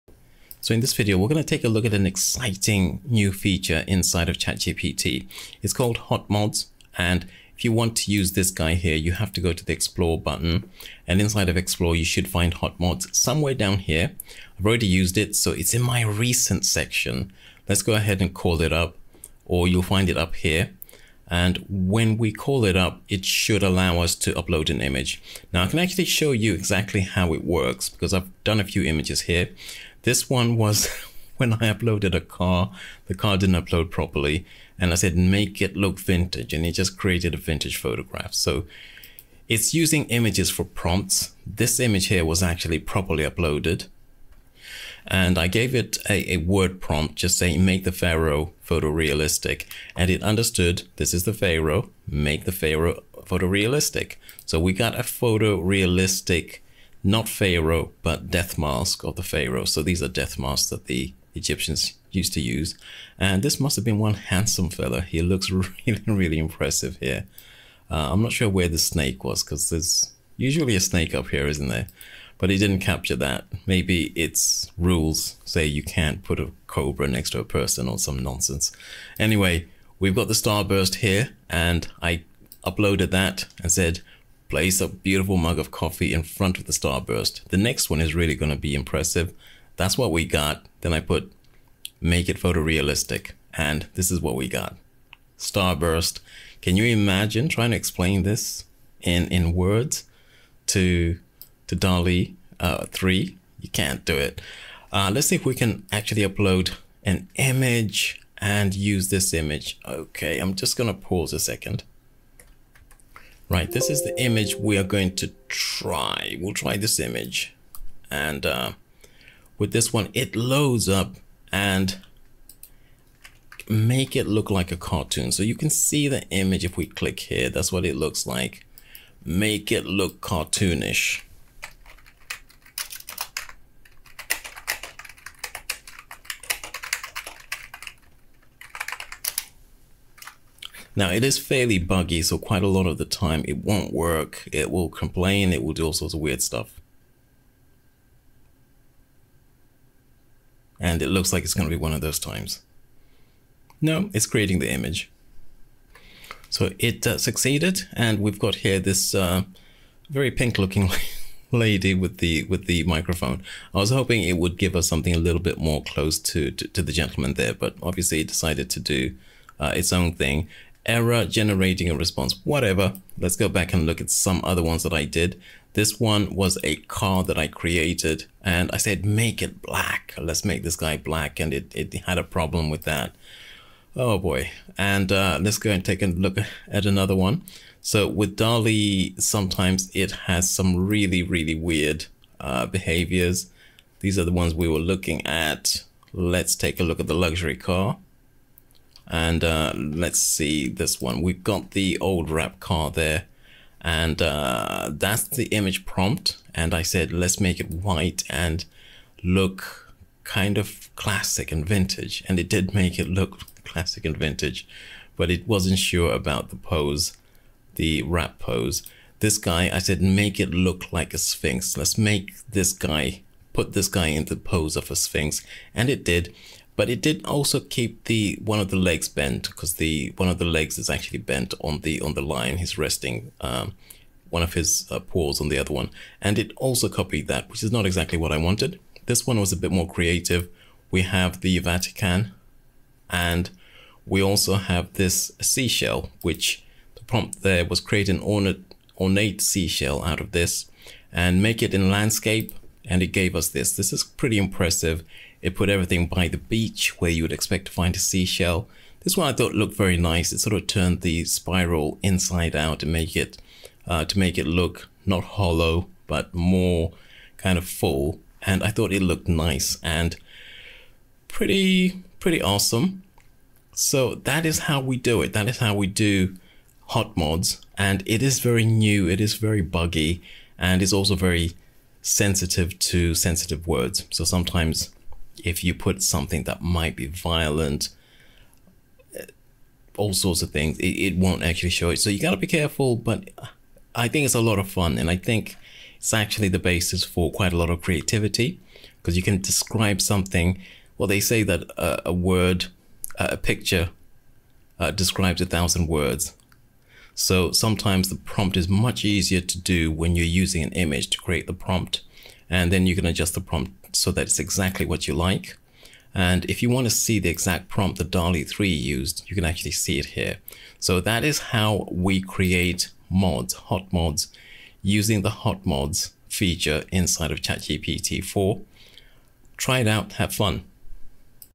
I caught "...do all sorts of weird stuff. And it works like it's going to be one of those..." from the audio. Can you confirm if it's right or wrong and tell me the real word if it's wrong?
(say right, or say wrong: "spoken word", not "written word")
wrong: "looks", not "works".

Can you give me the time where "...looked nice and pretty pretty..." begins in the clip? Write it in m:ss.
4:29.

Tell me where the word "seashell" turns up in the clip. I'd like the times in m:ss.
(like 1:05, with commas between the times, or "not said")
4:05, 4:09, 4:17.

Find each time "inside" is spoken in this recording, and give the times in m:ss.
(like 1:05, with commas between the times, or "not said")
0:03, 0:11, 4:22, 5:26.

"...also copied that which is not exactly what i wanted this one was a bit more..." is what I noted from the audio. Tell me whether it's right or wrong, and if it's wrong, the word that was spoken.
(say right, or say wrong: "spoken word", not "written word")
right.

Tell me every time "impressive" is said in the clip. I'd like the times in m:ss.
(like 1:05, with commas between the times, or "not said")
1:06, 1:28, 4:14.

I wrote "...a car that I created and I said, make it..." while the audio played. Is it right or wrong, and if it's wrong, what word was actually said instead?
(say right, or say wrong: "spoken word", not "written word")
right.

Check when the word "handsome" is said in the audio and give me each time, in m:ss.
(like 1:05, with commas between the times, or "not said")
1:04.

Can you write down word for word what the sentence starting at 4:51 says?
So you got to be careful, but I think it's a lot of fun.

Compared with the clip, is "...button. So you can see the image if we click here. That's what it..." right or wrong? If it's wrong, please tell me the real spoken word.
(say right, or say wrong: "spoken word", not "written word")
wrong: "cartoon", not "button".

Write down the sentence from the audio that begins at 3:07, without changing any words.
So with DALL-E, sometimes it has some really, really weird uh, behaviors.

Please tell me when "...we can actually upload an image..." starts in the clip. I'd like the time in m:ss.
1:45.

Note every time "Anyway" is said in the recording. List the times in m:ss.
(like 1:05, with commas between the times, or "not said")
1:19.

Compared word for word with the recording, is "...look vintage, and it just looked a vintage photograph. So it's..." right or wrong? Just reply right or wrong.
wrong.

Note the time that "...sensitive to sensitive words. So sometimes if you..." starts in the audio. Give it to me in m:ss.
4:42.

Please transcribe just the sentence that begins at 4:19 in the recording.
This one I thought looked very nice.